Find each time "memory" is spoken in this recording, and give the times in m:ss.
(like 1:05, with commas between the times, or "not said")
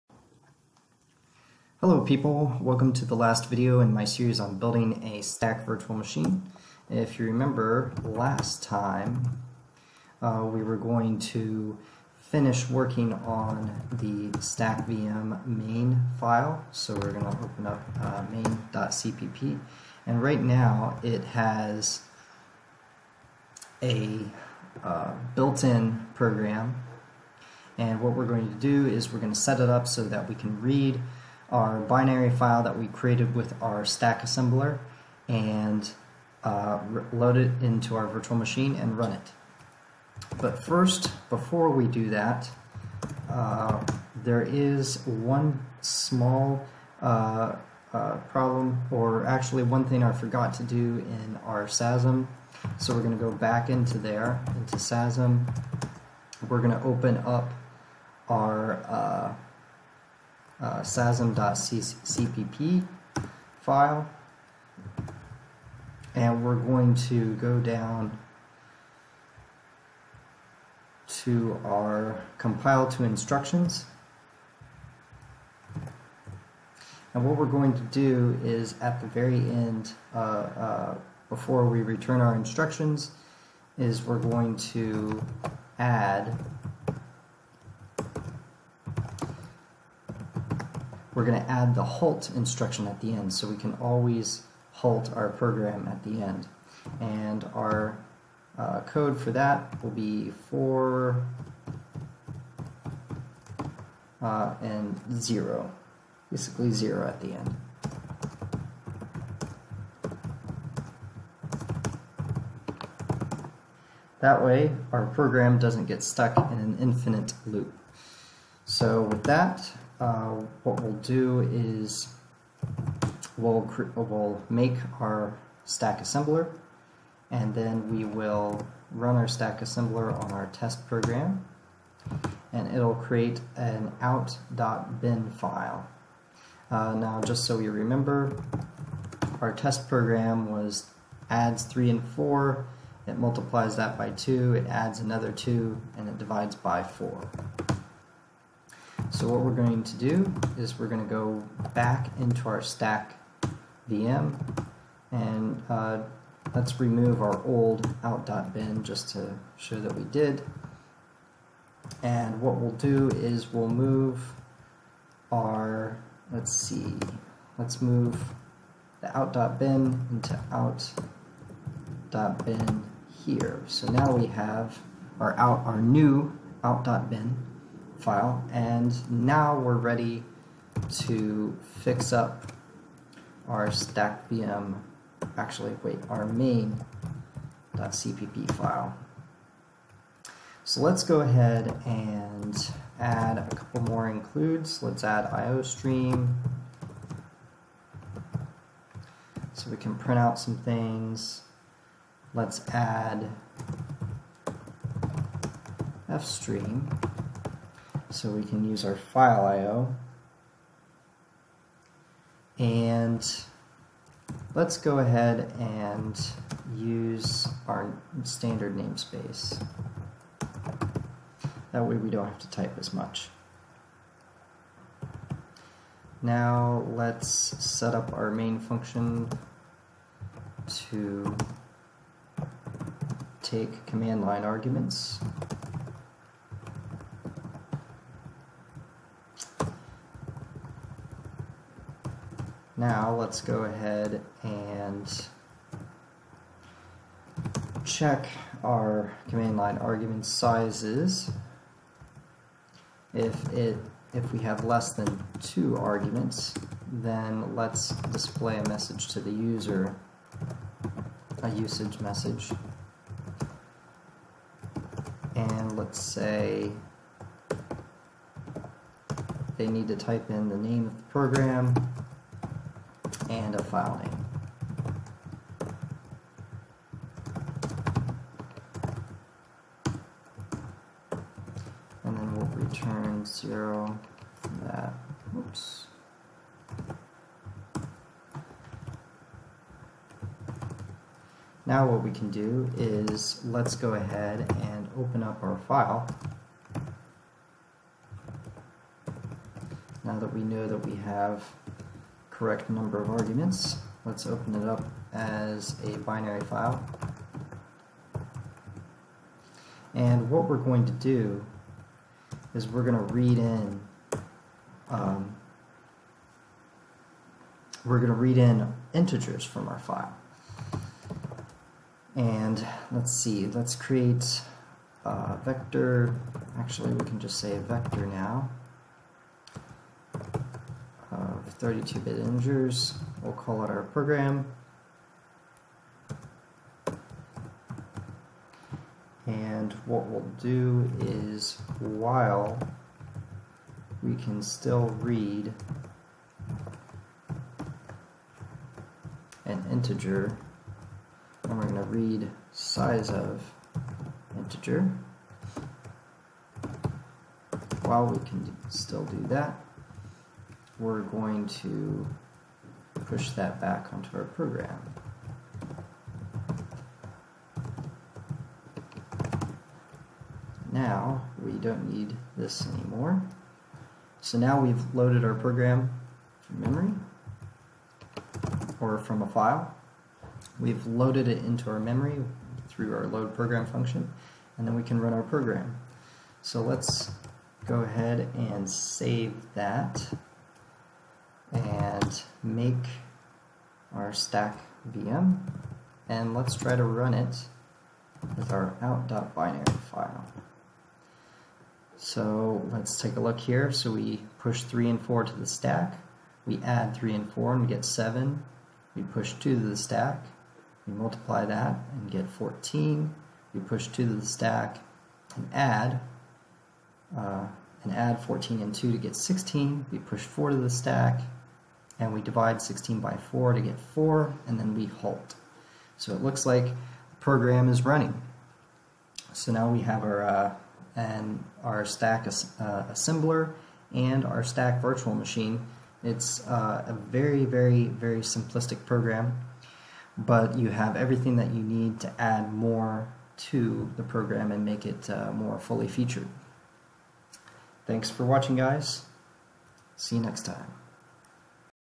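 6:16, 6:21.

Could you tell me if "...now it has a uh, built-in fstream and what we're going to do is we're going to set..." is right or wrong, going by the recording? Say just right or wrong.
wrong.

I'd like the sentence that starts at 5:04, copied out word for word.
Let's open it up as a binary file.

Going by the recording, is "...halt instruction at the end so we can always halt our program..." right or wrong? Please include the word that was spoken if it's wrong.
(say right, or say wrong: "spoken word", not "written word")
right.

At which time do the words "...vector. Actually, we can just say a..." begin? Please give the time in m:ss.
5:25.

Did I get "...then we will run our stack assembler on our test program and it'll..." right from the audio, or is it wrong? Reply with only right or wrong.
right.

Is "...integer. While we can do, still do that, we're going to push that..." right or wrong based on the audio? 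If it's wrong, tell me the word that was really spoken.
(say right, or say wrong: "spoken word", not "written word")
right.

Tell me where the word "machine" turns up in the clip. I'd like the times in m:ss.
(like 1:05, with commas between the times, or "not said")
0:05, 0:38, 7:15.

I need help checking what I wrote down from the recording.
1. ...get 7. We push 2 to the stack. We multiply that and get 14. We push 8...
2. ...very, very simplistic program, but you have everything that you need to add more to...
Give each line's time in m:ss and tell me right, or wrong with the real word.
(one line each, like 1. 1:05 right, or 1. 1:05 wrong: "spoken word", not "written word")
1. 6:47 wrong: "2", not "8"
2. 7:17 right.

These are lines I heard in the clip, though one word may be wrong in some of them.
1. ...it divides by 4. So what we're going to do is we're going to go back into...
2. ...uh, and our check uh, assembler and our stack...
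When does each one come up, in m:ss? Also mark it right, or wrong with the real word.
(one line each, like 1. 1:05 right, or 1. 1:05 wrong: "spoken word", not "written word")
1. 2:26 right
2. 7:10 wrong: "stack", not "check".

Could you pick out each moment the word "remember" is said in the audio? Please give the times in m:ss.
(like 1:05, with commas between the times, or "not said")
0:07, 2:17.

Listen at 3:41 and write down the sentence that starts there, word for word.
That way we don't have to type as much.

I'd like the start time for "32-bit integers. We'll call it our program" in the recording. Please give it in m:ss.
5:31.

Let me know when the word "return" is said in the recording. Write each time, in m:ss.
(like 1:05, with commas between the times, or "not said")
1:21, 4:42.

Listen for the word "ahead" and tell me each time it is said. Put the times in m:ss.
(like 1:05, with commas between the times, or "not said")
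3:11, 3:34, 4:03, 4:53, 6:27.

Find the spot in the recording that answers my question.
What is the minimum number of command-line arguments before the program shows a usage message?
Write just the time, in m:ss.
4:15.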